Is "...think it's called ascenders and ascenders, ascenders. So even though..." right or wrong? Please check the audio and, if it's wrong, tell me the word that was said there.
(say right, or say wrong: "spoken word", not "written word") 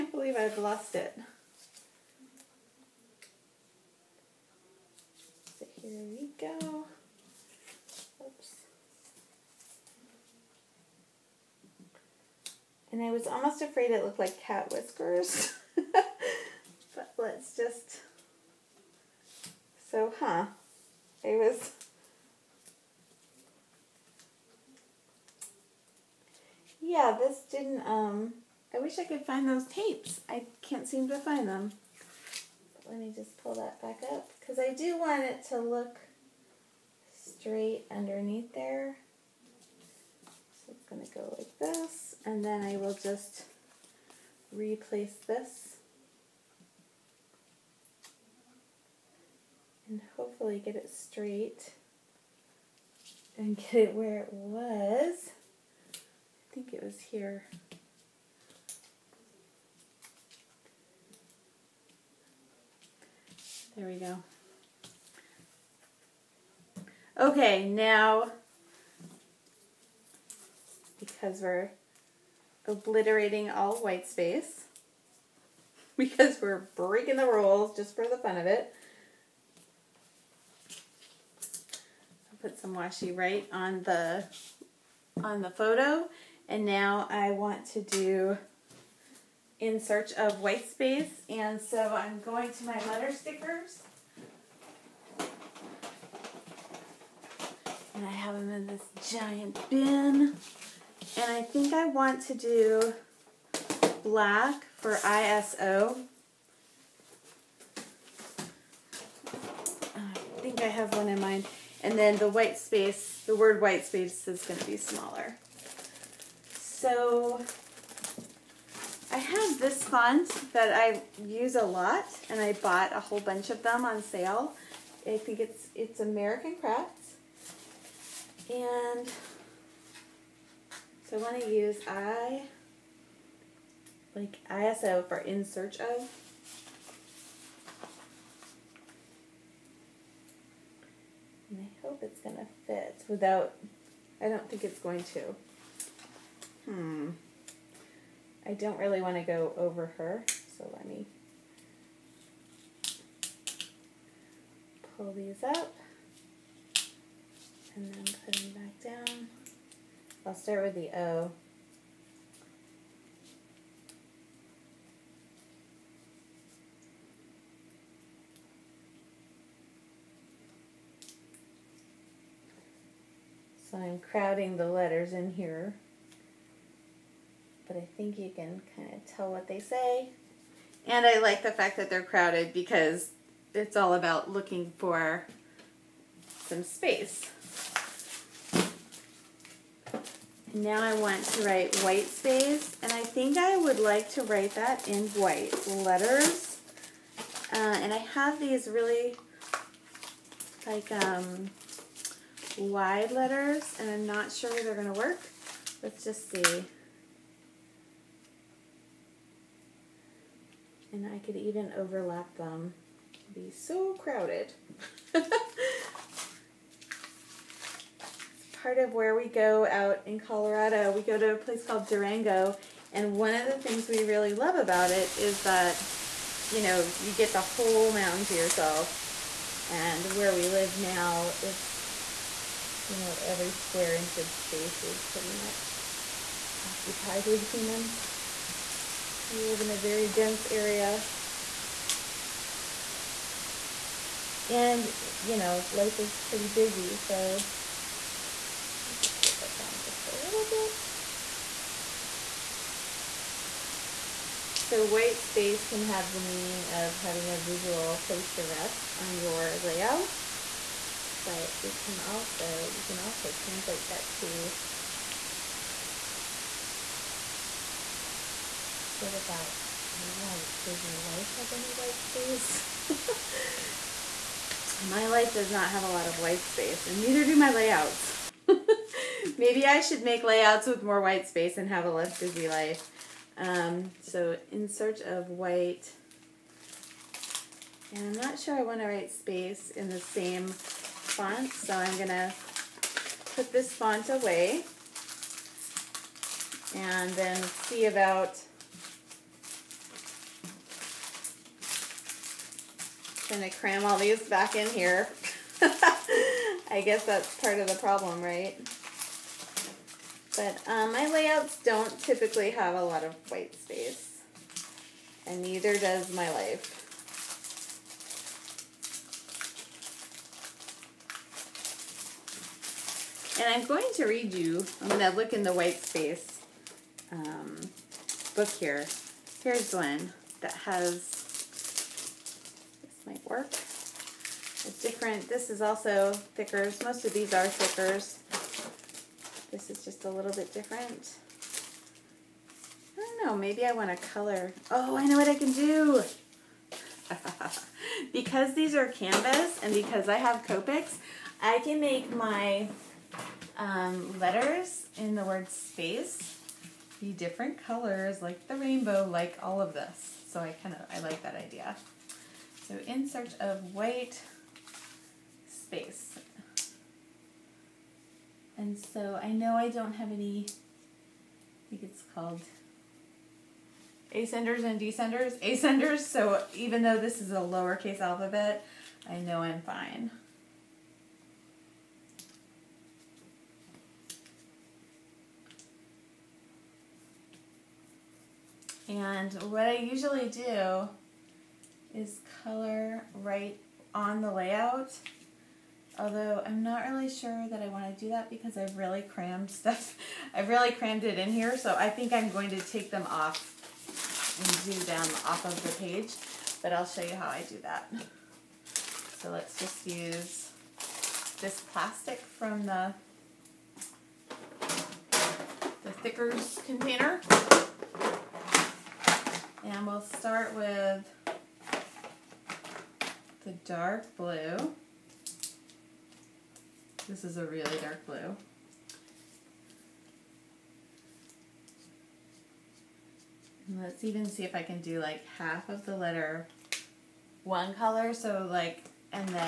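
wrong: "descenders", not "ascenders".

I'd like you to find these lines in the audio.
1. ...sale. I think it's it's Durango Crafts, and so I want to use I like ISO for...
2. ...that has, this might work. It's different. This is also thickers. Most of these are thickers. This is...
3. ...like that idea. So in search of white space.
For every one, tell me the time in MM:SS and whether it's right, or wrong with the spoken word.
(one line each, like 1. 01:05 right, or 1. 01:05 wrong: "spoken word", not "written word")
1. 02:04 wrong: "American", not "Durango"
2. 05:30 right
3. 06:01 right.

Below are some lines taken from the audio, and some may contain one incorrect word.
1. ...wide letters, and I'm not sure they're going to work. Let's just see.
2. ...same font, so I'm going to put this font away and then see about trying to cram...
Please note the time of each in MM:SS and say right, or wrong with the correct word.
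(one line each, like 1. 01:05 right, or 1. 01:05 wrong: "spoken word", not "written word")
1. 03:22 right
2. 04:49 right.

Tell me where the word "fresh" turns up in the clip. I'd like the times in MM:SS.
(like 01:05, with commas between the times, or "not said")
not said.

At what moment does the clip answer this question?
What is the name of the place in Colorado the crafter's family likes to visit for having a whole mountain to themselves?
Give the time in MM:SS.
03:41.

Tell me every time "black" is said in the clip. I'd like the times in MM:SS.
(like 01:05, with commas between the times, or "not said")
01:44.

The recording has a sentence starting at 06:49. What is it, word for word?
So let's just use this plastic from the, the Thickers container.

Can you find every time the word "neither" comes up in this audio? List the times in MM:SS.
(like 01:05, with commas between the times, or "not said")
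04:37, 05:15.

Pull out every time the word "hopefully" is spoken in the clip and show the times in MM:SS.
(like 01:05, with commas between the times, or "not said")
00:50.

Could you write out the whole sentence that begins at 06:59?
And we'll start with the dark blue.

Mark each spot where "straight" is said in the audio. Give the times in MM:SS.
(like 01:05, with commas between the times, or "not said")
00:37, 00:50.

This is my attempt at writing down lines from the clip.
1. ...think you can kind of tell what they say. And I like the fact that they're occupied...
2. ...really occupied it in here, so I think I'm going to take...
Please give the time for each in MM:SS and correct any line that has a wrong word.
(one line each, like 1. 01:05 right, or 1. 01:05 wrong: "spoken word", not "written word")
1. 02:57 wrong: "crowded", not "occupied"
2. 06:40 wrong: "crammed", not "occupied".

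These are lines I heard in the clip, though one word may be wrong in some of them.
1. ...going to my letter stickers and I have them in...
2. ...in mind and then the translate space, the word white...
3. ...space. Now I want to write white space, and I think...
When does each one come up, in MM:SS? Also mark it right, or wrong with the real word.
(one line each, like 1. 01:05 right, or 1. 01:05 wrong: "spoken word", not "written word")
1. 01:32 right
2. 01:51 wrong: "white", not "translate"
3. 03:06 right.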